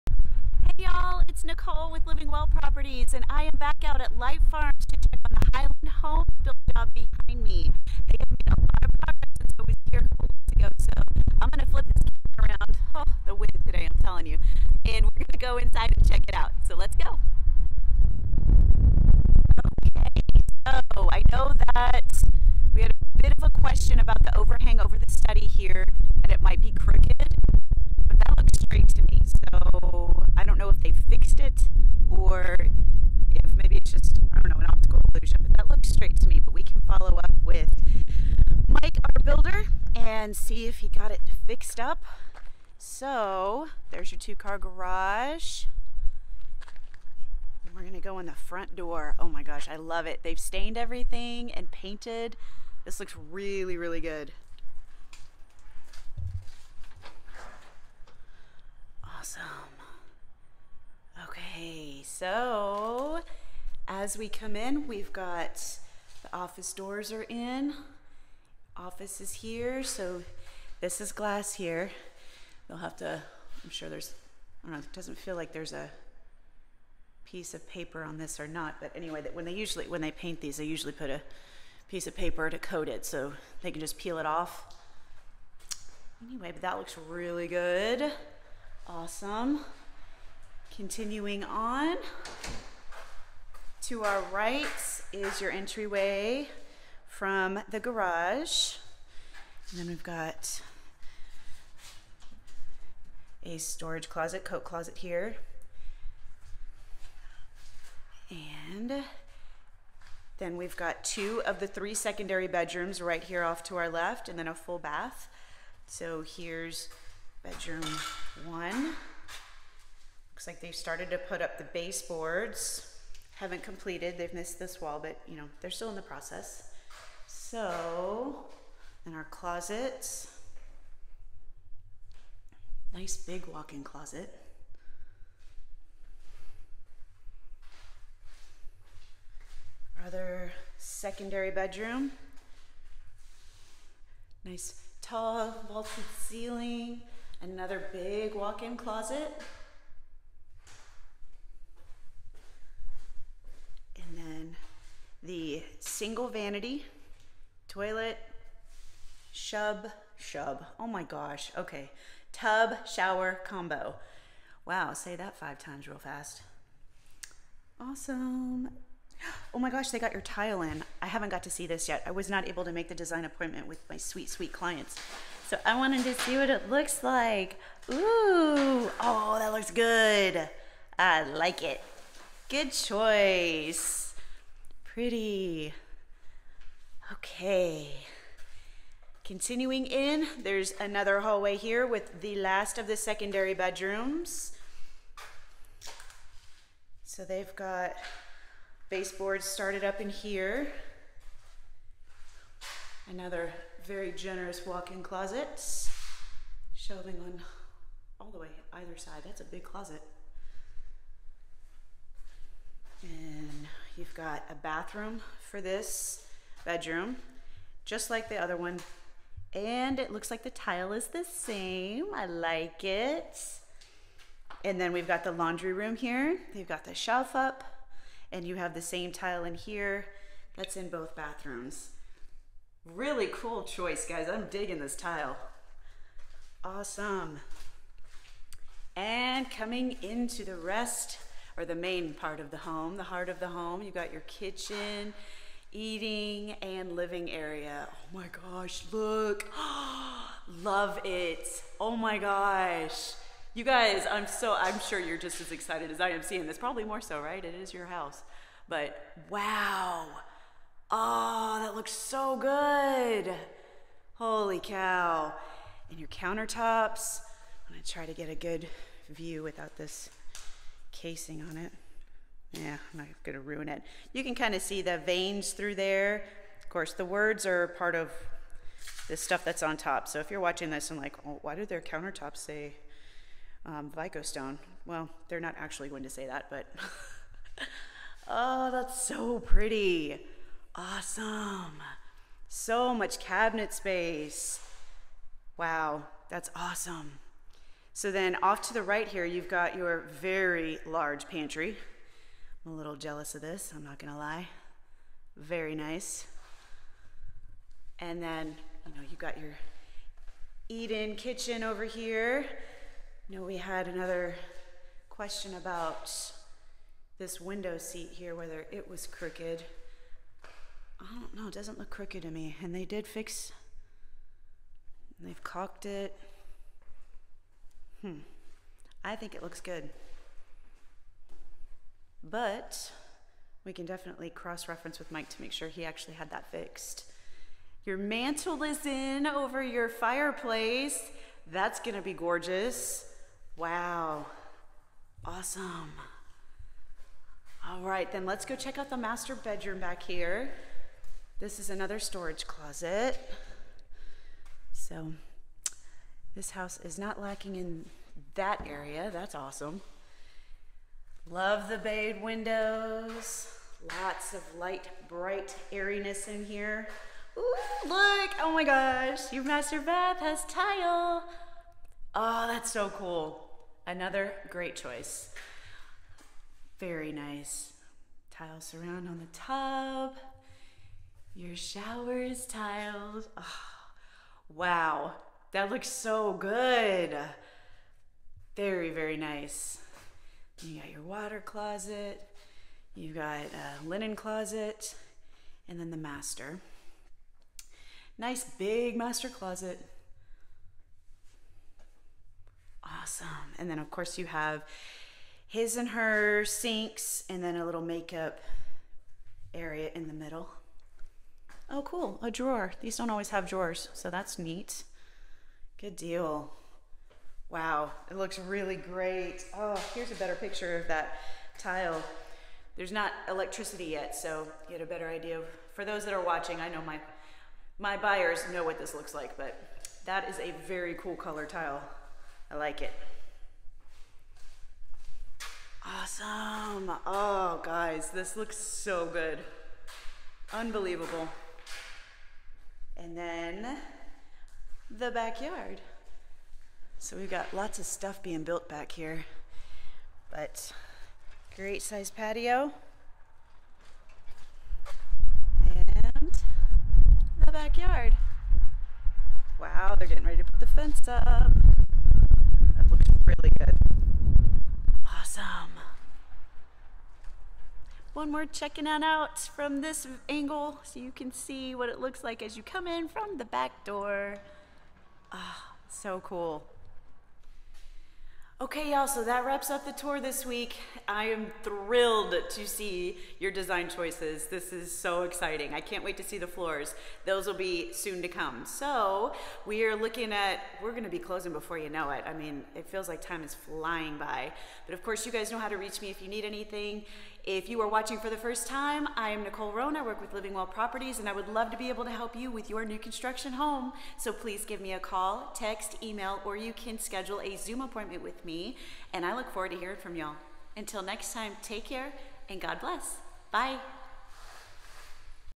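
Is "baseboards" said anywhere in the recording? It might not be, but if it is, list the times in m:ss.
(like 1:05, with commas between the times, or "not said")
2:01, 3:18.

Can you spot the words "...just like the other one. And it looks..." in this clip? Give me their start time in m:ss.
3:37.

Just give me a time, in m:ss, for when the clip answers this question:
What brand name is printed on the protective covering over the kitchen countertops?
4:43.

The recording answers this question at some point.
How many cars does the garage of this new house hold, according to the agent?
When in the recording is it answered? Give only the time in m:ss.
0:44.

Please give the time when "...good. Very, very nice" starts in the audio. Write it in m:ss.
6:26.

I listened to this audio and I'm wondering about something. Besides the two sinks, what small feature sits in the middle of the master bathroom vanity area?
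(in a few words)
makeup area.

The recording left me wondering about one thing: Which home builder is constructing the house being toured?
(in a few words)
Highland Home.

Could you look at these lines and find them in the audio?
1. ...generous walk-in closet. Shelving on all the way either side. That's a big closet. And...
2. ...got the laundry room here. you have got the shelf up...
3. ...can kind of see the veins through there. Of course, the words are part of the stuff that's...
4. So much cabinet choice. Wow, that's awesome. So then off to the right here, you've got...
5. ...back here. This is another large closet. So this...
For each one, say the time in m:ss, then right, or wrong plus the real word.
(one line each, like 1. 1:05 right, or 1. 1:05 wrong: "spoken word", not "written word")
1. 3:24 right
2. 3:45 right
3. 4:34 right
4. 4:52 wrong: "space", not "choice"
5. 5:49 wrong: "storage", not "large".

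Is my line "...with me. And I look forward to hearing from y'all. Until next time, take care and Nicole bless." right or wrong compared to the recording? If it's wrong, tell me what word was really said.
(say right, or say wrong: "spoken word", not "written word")
wrong: "God", not "Nicole".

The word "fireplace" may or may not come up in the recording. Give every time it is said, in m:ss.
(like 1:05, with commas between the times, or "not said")
5:39.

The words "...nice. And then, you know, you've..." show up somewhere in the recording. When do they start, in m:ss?
5:05.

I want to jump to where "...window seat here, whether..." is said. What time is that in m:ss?
5:17.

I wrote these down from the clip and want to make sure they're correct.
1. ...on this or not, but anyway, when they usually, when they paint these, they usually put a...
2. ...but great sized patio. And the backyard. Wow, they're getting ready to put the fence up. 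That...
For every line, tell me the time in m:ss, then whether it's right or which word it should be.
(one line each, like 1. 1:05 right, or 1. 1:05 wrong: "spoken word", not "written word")
1. 1:18 right
2. 7:30 right.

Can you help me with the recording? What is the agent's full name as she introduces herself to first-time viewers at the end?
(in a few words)
Nicole Rohn.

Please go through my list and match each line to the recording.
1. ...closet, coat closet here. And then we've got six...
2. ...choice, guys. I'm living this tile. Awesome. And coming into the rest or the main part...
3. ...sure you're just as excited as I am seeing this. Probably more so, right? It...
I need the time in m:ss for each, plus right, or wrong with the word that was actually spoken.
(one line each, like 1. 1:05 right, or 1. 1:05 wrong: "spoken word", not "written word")
1. 1:44 wrong: "two", not "six"
2. 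3:53 wrong: "digging", not "living"
3. 4:14 right.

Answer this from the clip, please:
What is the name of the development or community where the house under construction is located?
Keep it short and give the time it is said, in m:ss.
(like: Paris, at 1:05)
Light Farms, at 0:04.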